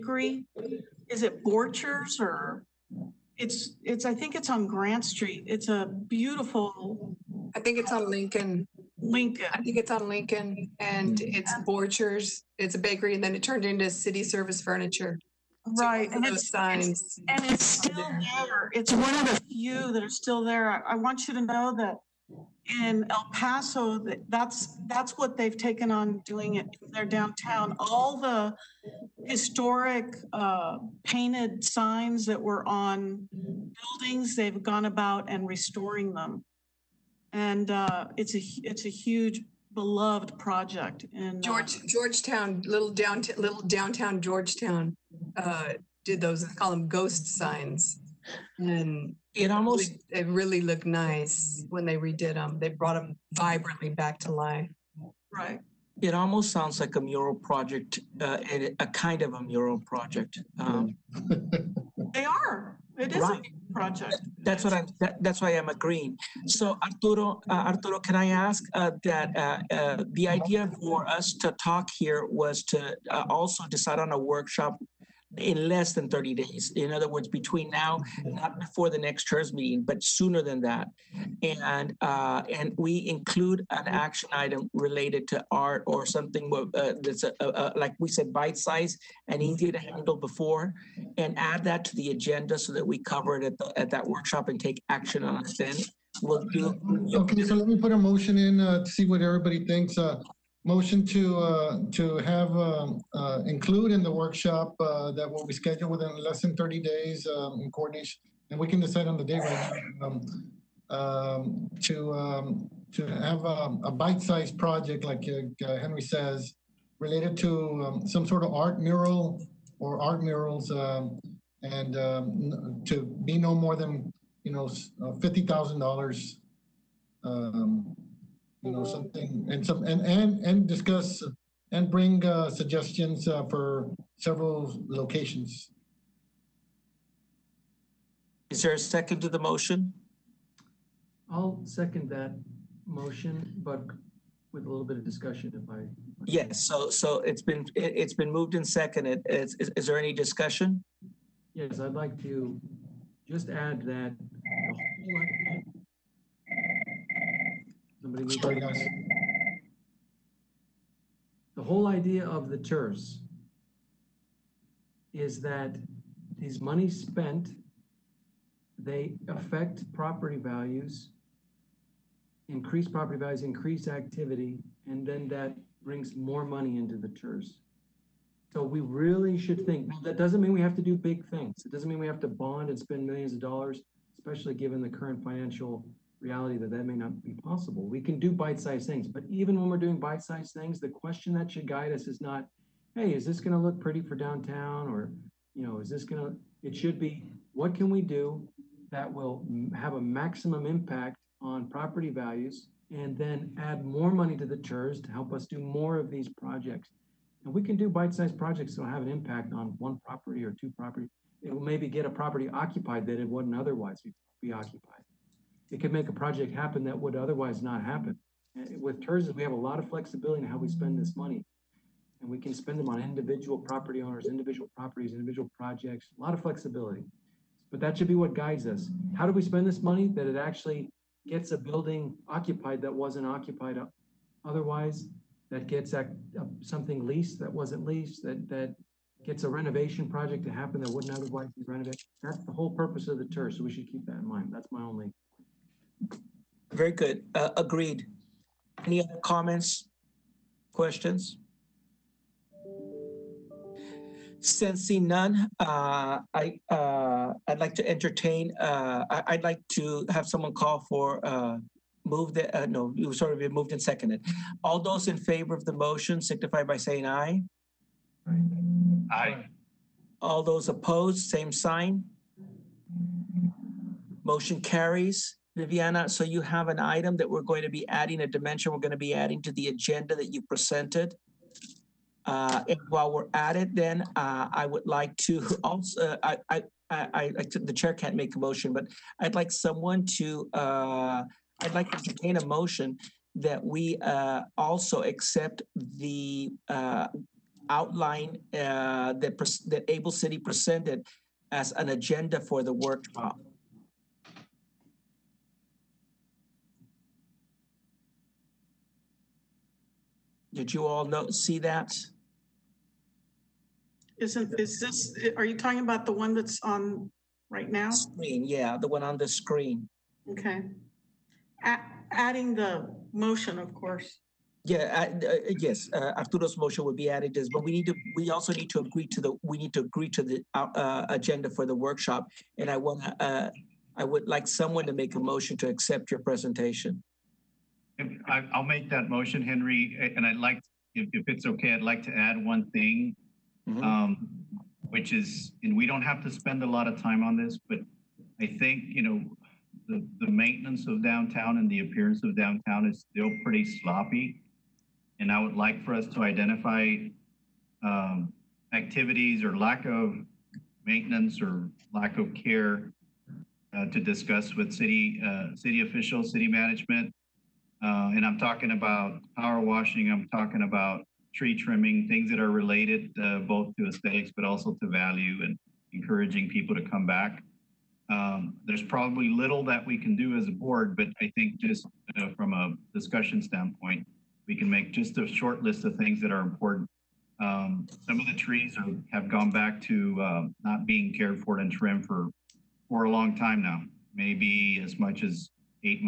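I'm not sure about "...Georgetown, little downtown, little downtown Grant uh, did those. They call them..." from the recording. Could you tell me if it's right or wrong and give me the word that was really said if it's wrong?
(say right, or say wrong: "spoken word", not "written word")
wrong: "Georgetown", not "Grant".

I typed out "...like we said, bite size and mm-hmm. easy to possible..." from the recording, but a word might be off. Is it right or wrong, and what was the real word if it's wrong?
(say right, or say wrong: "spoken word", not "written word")
wrong: "handle", not "possible".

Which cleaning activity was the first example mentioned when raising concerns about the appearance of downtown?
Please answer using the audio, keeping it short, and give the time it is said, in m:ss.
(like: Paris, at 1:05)
power washing, at 6:09.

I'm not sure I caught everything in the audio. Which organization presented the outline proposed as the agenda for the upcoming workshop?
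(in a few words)
Able City.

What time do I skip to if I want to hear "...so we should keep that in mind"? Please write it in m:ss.
4:03.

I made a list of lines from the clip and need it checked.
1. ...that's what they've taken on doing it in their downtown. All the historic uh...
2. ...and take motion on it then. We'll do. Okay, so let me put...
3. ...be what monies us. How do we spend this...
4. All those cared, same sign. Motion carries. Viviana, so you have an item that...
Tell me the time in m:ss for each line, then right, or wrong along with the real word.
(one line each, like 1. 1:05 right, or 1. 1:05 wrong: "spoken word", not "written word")
1. 0:24 right
2. 1:34 wrong: "action", not "motion"
3. 3:48 wrong: "guides", not "monies"
4. 4:30 wrong: "opposed", not "cared".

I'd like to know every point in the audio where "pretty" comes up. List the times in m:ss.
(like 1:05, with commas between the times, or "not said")
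3:13, 5:53.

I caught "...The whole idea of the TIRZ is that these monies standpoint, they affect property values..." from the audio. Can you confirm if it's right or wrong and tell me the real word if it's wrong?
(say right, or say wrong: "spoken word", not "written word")
wrong: "spent", not "standpoint".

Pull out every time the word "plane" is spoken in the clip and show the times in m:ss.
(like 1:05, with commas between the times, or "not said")
not said.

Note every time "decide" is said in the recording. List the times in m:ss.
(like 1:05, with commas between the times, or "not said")
1:13, 1:48.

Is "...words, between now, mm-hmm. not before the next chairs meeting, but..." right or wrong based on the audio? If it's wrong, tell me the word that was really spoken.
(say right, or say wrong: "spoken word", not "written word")
right.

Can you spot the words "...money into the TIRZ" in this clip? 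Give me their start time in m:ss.
2:56.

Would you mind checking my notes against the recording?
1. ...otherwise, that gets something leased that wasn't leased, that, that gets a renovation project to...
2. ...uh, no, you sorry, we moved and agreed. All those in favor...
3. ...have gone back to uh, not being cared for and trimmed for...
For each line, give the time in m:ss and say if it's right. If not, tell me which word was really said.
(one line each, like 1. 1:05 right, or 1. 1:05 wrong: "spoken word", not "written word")
1. 3:54 right
2. 4:22 wrong: "seconded", not "agreed"
3. 6:29 right.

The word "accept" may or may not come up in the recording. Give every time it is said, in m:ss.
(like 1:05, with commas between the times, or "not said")
4:55, 5:35.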